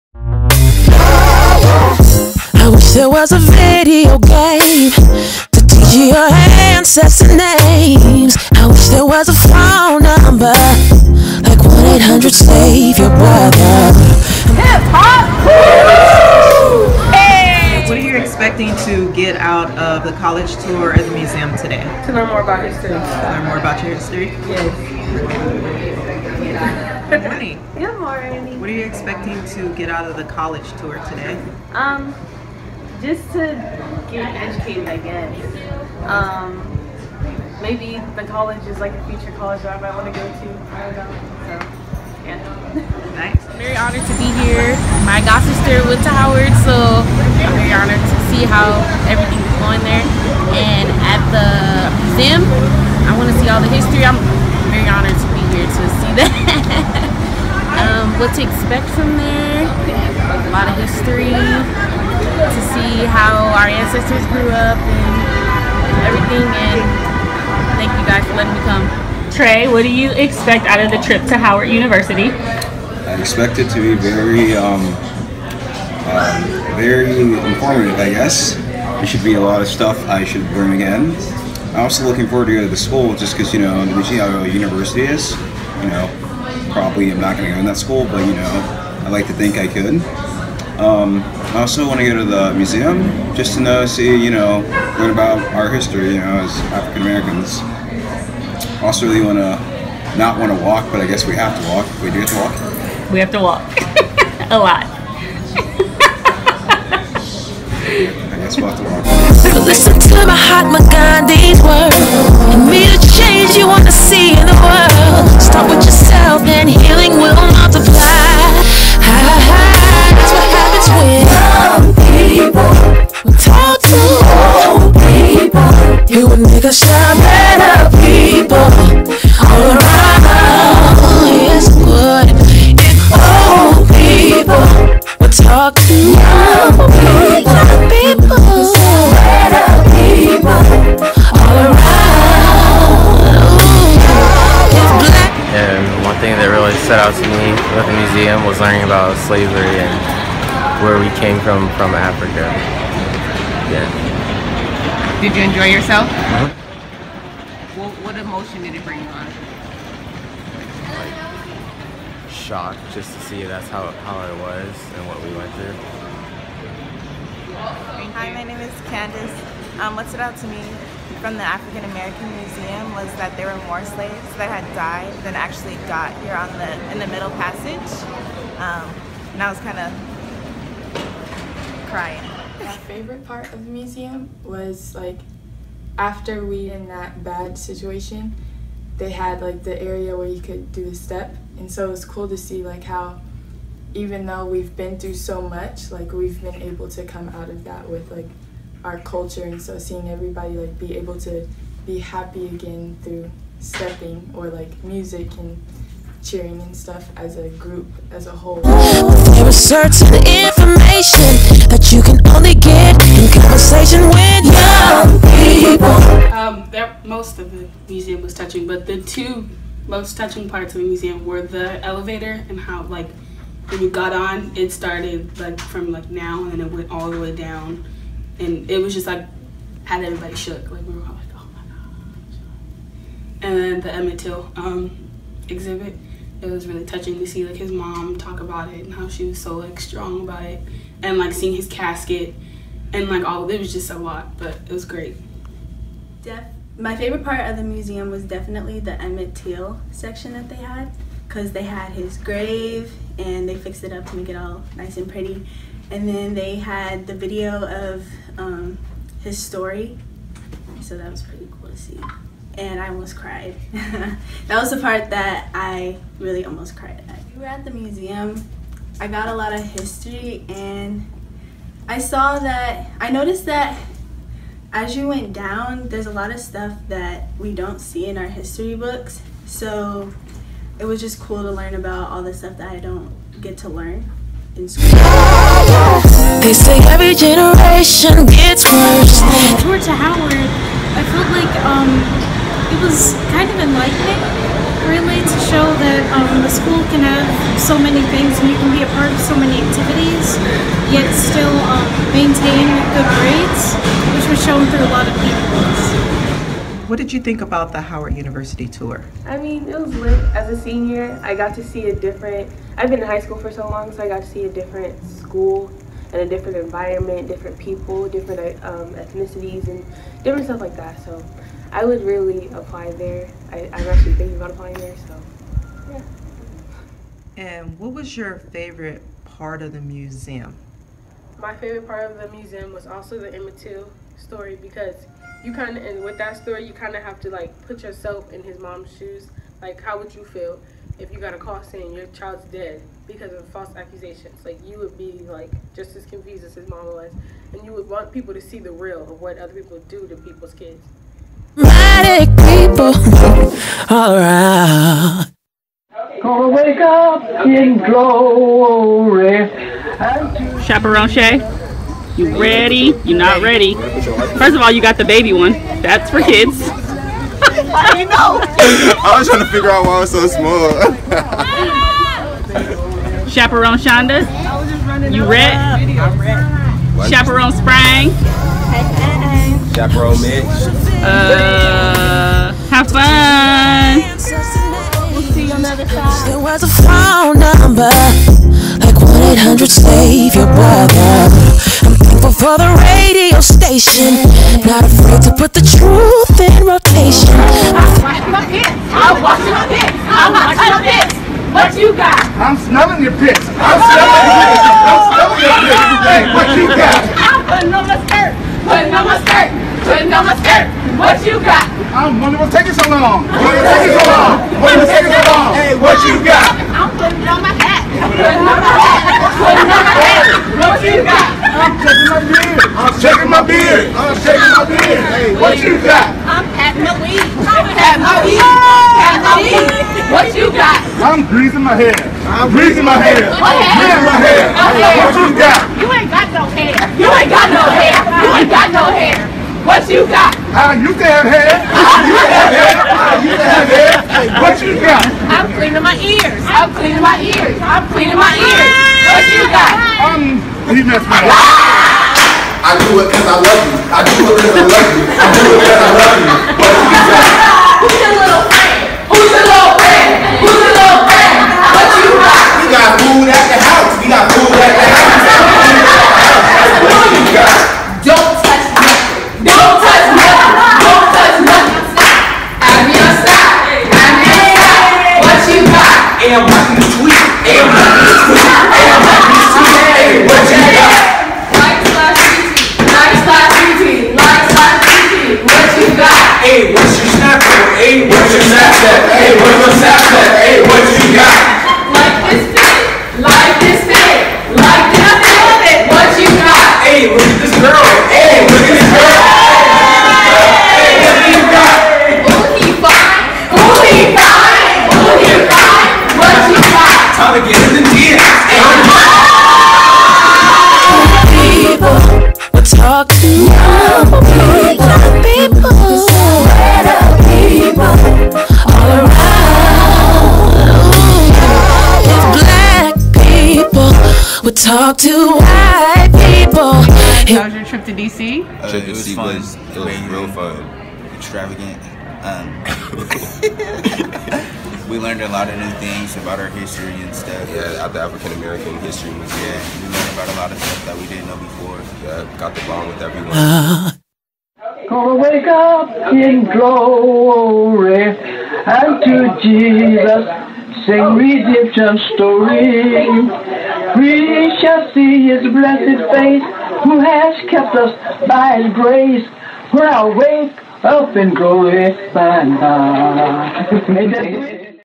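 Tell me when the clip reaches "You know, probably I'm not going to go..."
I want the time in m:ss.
1:25.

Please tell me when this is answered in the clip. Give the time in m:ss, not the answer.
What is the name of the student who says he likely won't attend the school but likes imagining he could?
1:09.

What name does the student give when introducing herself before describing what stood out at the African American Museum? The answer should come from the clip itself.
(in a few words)
Candace.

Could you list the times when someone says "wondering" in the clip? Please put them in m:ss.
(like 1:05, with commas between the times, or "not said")
6:52.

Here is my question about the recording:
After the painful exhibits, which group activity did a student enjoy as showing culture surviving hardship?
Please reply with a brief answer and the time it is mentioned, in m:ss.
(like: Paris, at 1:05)
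stepping, at 3:10.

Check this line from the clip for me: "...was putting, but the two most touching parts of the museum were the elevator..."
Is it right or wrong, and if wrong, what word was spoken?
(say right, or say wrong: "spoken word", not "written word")
wrong: "touching", not "putting".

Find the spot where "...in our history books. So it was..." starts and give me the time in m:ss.
4:38.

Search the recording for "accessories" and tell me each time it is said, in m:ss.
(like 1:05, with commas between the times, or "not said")
not said.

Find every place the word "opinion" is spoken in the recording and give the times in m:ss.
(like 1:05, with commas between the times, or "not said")
not said.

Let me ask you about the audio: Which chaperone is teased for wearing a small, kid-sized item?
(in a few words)
Shay.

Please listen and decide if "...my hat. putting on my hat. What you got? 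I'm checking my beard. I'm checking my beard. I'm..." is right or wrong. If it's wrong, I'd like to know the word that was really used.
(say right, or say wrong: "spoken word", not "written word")
right.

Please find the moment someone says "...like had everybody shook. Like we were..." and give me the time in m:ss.
3:49.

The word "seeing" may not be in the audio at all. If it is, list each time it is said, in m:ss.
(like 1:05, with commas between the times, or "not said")
3:19, 4:01.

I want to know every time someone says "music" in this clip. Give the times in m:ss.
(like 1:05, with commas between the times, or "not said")
3:24.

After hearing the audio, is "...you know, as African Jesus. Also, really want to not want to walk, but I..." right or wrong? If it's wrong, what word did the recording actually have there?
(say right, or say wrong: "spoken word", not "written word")
wrong: "Americans", not "Jesus".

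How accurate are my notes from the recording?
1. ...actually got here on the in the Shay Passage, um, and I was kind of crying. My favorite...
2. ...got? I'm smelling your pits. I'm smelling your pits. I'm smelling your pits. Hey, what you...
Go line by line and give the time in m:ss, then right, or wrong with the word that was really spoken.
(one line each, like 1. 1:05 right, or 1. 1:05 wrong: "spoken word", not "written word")
1. 2:55 wrong: "Middle", not "Shay"
2. 6:41 right.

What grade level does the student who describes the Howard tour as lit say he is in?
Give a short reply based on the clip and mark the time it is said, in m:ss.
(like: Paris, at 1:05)
senior, at 5:10.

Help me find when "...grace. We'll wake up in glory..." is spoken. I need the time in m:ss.
9:18.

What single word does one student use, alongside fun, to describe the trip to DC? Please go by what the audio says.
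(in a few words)
extravagant.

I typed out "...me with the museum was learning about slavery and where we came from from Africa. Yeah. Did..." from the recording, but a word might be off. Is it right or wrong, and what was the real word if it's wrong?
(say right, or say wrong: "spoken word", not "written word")
right.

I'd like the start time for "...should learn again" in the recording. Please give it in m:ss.
1:20.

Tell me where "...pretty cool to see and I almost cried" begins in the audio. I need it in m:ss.
4:21.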